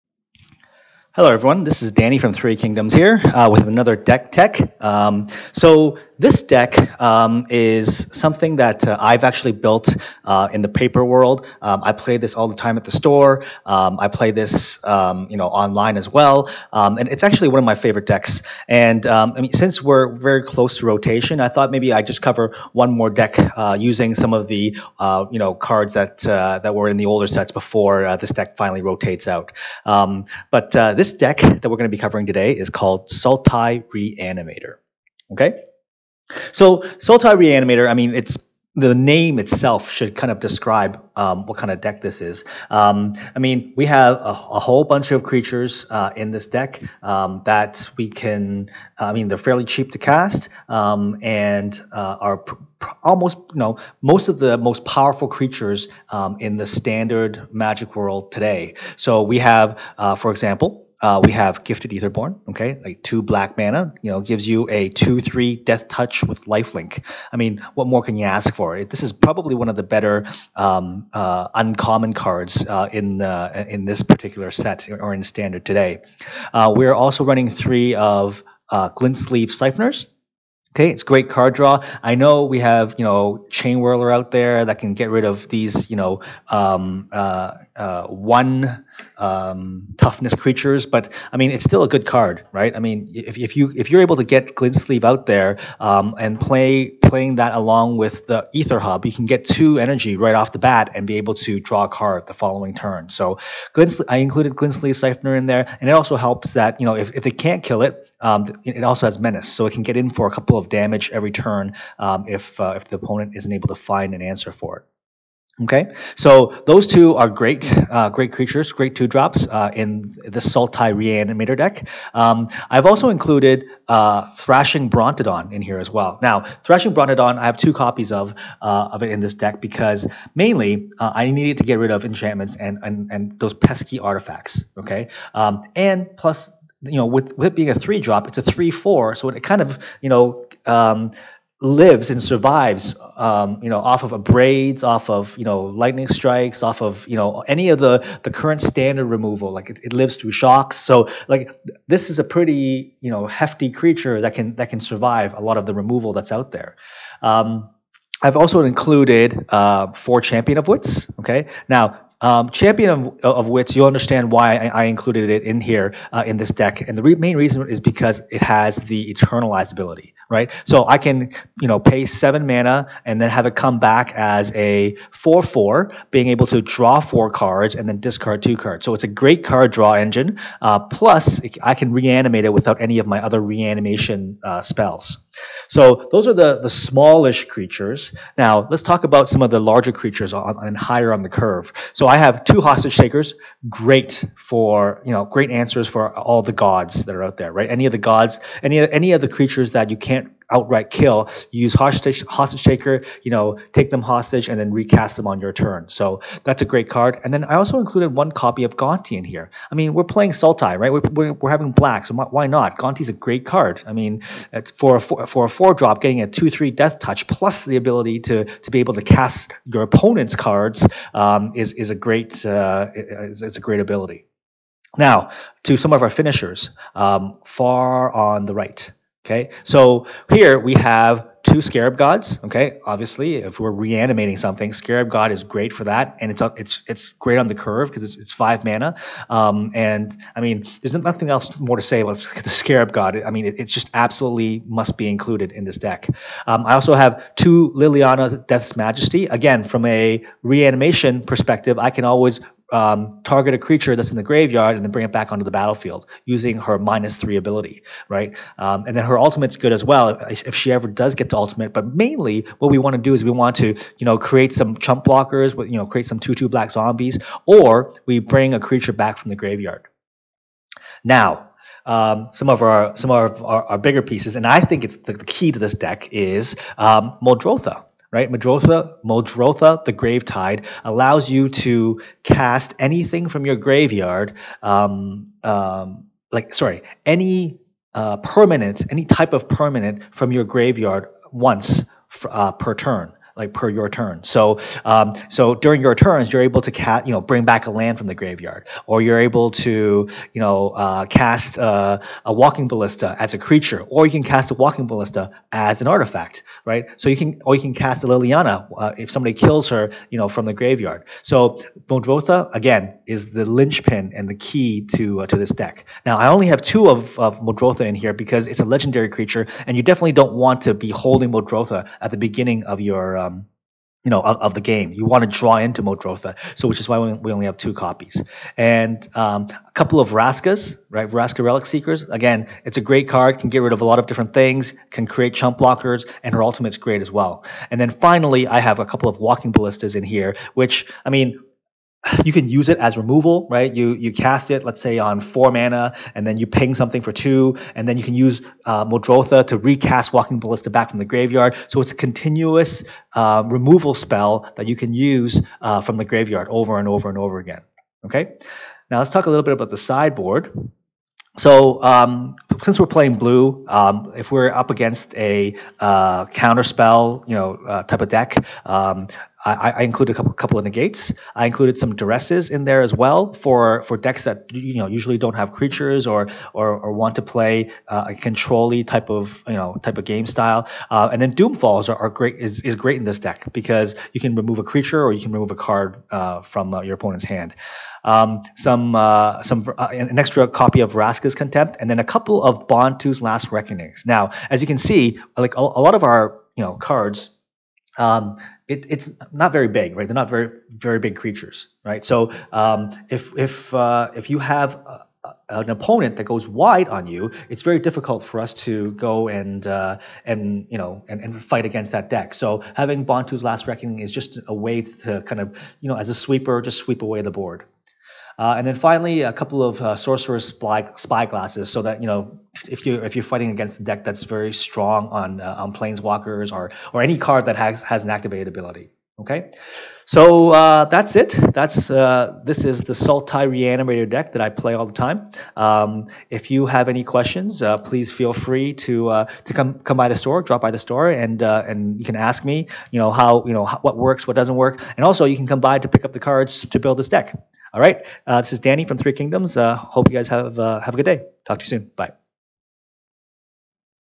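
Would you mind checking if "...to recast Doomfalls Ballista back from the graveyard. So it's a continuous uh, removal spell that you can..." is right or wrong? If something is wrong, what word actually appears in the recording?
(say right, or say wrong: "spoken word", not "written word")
wrong: "Walking", not "Doomfalls".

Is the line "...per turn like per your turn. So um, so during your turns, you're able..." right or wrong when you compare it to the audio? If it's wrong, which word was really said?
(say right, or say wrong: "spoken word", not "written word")
right.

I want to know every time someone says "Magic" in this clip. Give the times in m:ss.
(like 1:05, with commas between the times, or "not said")
0:57.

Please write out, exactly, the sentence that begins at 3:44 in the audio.
Now, to some of our finishers, um, far on the right.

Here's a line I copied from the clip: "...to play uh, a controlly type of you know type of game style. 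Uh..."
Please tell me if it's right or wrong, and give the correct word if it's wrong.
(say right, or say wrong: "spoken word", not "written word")
right.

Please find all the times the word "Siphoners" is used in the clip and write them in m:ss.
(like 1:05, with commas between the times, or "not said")
1:19, 1:44.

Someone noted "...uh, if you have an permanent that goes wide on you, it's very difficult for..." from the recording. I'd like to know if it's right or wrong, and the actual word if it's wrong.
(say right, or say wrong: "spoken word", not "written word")
wrong: "opponent", not "permanent".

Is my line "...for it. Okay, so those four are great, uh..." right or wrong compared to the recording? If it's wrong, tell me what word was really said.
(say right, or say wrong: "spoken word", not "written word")
wrong: "two", not "four".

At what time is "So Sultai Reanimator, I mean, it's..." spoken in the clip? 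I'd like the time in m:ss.
0:36.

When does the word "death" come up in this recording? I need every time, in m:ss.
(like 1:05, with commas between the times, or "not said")
1:05, 3:36, 4:08.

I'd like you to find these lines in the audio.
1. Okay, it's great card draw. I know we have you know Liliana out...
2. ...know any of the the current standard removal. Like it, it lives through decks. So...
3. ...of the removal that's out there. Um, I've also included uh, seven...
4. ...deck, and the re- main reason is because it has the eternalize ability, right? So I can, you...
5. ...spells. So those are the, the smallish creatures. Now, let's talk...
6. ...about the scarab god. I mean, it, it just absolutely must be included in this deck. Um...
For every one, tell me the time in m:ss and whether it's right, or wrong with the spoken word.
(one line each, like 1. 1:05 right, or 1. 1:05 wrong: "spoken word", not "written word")
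1. 1:20 wrong: "Chainwhirler", not "Liliana"
2. 2:27 wrong: "shocks", not "decks"
3. 2:35 wrong: "four", not "seven"
4. 2:46 right
5. 3:04 right
6. 4:01 right.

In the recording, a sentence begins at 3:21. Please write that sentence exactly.
You use hostage hostage taker, you know, take them hostage and then recast them on your turn.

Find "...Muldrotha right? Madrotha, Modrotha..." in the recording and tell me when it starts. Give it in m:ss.
4:37.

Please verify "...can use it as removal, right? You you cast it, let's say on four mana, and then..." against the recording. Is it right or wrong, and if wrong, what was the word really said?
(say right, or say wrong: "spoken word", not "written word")
right.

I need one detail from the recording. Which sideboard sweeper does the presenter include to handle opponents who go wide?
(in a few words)
Bontu's Last Reckoning.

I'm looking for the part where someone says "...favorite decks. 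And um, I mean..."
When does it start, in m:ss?
0:17.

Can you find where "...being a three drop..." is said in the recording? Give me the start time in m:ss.
2:17.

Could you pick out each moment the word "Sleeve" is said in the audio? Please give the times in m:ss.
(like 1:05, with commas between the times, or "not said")
1:19, 1:34, 1:44.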